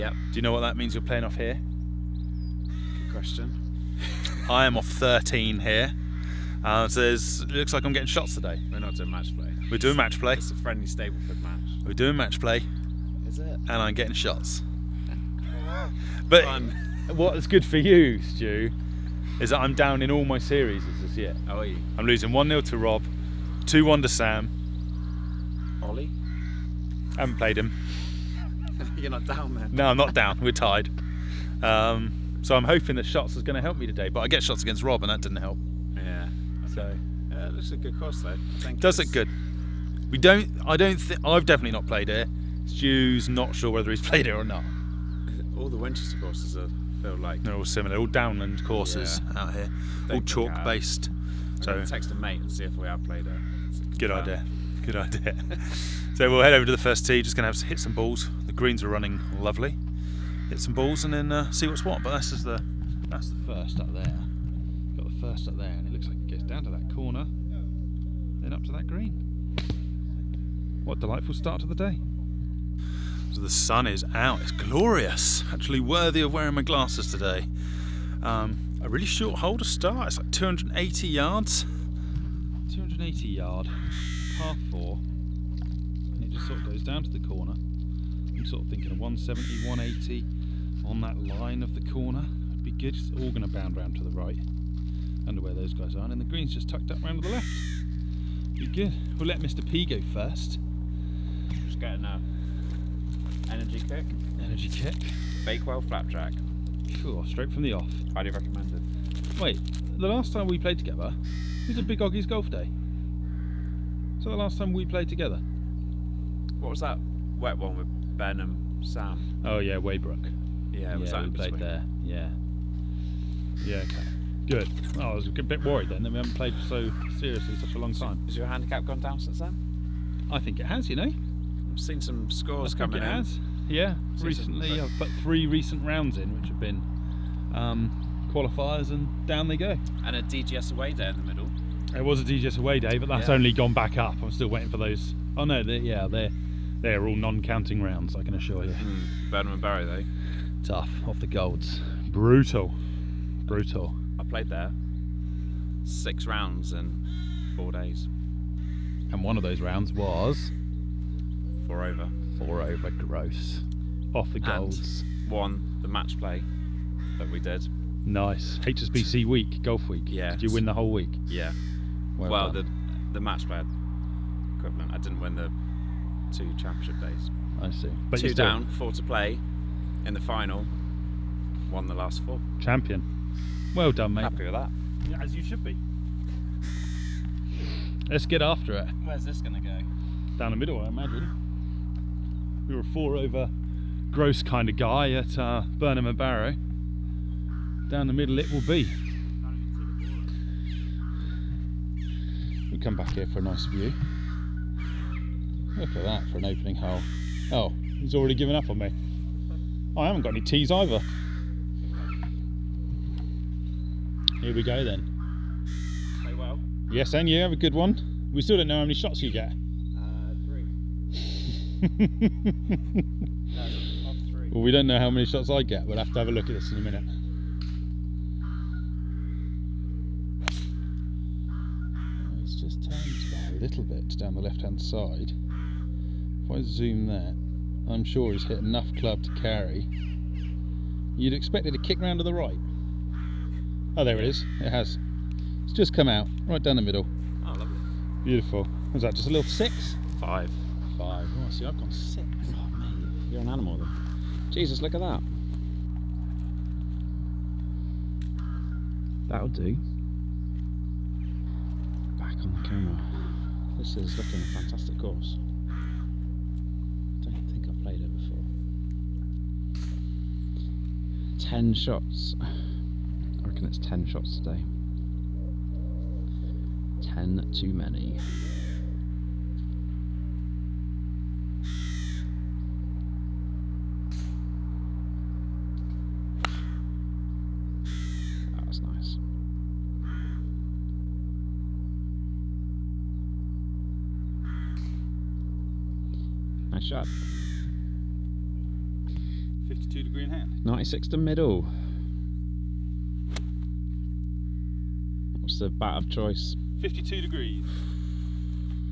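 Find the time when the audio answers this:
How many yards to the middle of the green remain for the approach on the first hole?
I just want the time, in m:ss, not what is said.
5:00.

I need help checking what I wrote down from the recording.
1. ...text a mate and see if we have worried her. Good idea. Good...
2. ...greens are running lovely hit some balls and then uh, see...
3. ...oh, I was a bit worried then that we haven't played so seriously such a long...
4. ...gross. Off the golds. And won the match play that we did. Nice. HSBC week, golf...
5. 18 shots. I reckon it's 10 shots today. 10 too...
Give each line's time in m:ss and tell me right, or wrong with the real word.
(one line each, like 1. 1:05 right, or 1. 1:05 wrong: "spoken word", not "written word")
1. 0:51 wrong: "played", not "worried"
2. 0:58 right
3. 2:05 right
4. 2:42 right
5. 4:31 wrong: "10", not "18".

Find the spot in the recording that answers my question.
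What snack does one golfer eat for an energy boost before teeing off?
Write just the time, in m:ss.
1:45.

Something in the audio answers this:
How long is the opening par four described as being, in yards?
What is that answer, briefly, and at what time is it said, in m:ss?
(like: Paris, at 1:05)
280, at 1:22.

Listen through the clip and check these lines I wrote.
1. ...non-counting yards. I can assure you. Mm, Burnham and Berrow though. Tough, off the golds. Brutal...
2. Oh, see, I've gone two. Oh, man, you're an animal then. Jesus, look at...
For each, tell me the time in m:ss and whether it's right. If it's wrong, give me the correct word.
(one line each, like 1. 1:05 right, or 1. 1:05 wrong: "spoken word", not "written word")
1. 2:27 wrong: "rounds", not "yards"
2. 4:11 wrong: "six", not "two".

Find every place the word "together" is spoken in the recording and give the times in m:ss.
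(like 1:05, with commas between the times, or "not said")
1:50, 1:55.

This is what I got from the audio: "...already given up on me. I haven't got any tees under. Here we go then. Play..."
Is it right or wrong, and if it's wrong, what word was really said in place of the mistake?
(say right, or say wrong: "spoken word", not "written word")
wrong: "either", not "under".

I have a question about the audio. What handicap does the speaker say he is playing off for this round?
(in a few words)
13.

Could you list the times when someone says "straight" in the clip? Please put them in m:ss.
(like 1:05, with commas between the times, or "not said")
1:47.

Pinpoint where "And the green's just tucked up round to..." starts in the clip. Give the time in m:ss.
1:36.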